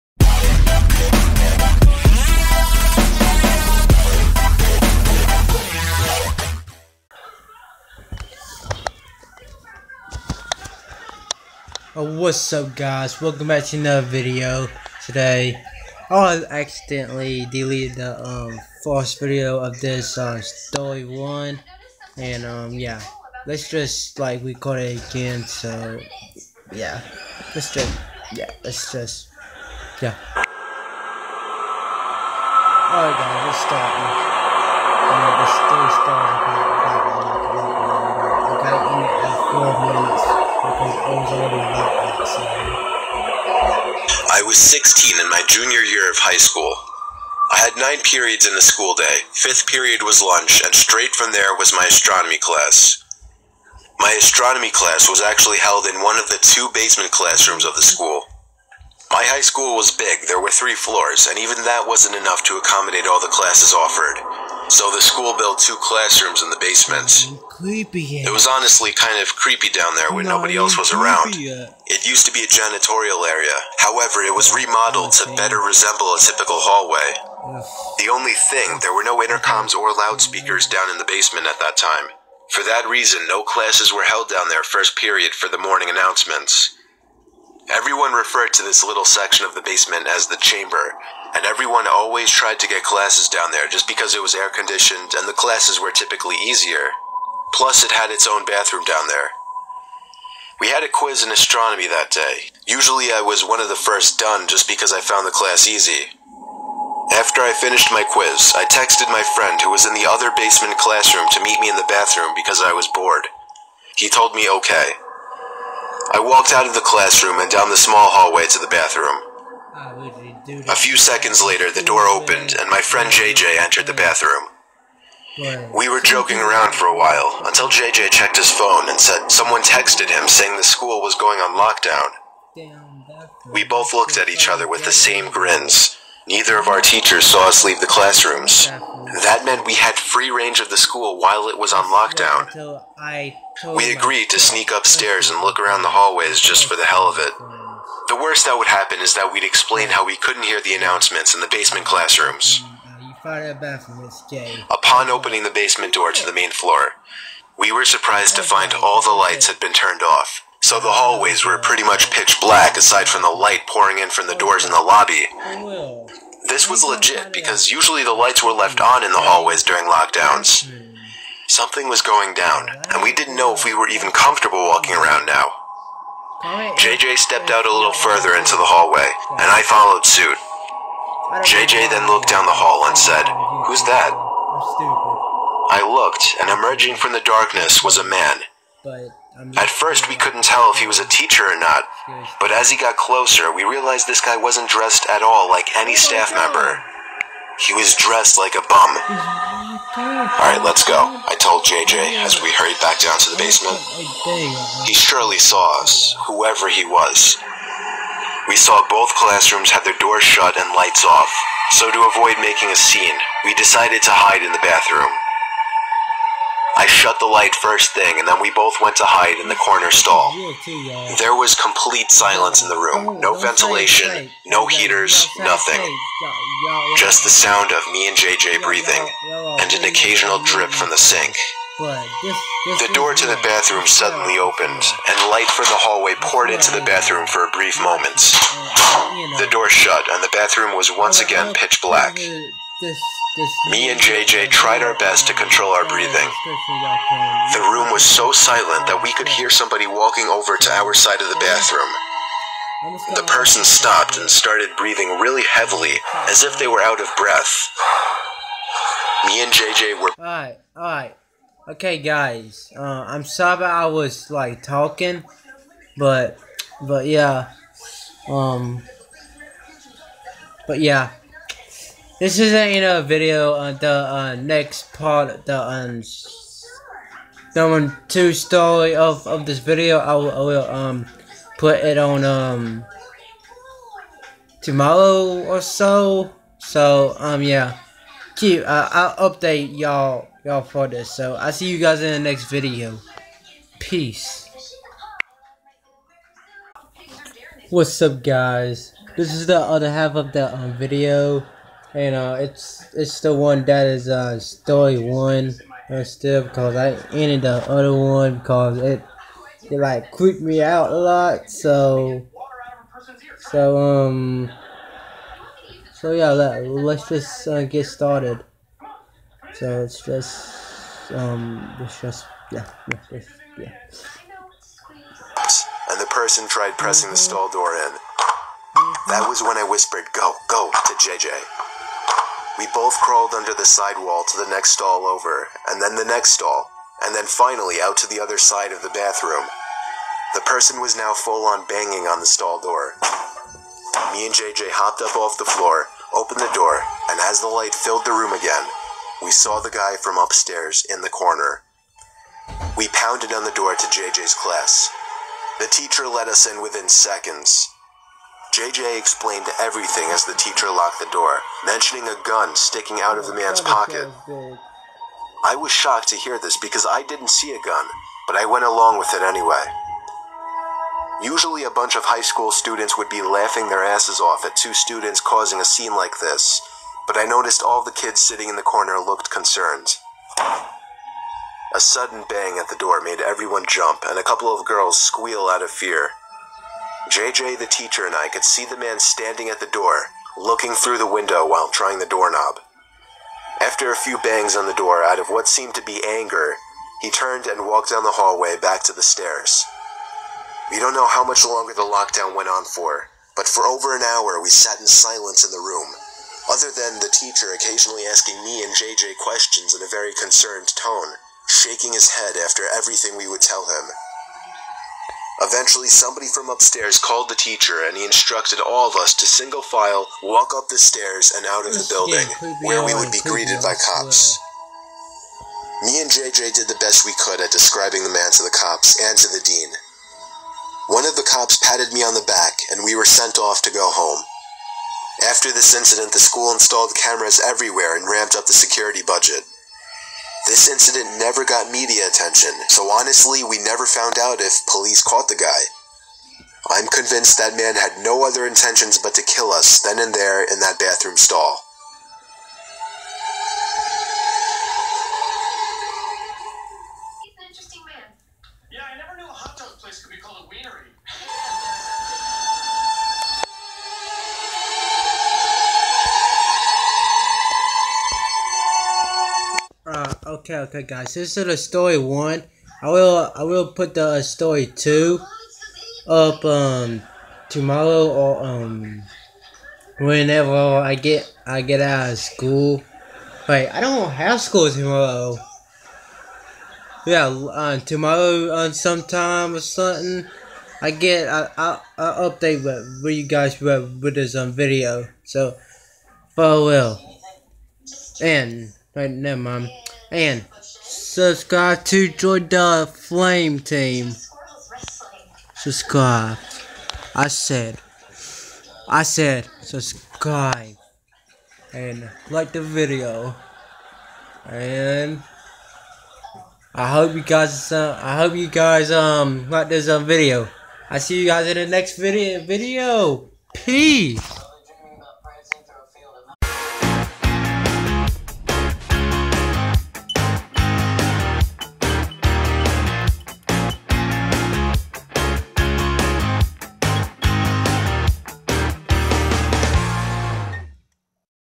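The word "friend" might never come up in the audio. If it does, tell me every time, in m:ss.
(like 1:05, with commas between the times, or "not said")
1:49, 2:02.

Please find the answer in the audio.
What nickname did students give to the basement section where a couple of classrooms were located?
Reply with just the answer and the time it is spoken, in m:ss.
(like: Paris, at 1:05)
The chamber, at 1:30.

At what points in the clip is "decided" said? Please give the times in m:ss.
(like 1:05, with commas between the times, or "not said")
3:33.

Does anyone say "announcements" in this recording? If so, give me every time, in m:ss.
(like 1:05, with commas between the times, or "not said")
1:25, 2:30.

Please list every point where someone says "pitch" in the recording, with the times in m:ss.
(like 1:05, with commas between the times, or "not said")
2:42, 4:01.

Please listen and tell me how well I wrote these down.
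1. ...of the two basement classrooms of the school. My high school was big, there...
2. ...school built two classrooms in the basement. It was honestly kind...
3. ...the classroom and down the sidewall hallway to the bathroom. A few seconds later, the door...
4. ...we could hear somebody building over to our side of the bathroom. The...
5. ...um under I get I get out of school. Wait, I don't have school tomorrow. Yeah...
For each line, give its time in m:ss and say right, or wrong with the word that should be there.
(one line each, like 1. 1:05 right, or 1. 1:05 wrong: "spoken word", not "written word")
1. 0:56 right
2. 1:05 right
3. 1:56 wrong: "small", not "sidewall"
4. 4:09 wrong: "walking", not "building"
5. 7:58 wrong: "whenever", not "under".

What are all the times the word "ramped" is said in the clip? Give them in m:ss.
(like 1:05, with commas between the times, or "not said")
7:18.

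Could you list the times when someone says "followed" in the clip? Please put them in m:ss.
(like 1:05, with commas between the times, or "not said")
2:59.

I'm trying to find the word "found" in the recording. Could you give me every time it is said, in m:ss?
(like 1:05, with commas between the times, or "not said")
1:45, 7:23.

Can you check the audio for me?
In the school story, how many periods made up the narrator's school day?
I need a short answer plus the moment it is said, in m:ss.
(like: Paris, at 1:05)
9, at 0:47.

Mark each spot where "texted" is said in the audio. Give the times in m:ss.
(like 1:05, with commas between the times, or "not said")
1:48, 2:09.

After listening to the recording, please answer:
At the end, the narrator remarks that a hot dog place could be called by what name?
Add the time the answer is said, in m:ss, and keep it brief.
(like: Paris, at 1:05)
Wienery, at 7:40.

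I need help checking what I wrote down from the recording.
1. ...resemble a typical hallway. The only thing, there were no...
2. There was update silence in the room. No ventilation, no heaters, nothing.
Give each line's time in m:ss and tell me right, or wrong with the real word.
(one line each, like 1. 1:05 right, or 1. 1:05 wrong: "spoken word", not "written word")
1. 1:15 right
2. 3:41 wrong: "complete", not "update".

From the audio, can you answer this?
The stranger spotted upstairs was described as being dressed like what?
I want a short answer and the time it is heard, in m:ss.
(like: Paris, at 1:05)
A bum, at 3:18.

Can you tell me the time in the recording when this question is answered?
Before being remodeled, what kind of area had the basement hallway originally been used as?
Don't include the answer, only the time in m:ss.
1:12.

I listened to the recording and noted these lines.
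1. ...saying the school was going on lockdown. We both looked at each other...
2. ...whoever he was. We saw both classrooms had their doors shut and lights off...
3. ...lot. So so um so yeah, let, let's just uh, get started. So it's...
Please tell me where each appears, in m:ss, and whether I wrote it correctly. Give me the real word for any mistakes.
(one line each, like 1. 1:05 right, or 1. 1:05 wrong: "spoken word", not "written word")
1. 2:10 right
2. 3:26 right
3. 5:10 right.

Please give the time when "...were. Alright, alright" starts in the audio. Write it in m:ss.
4:20.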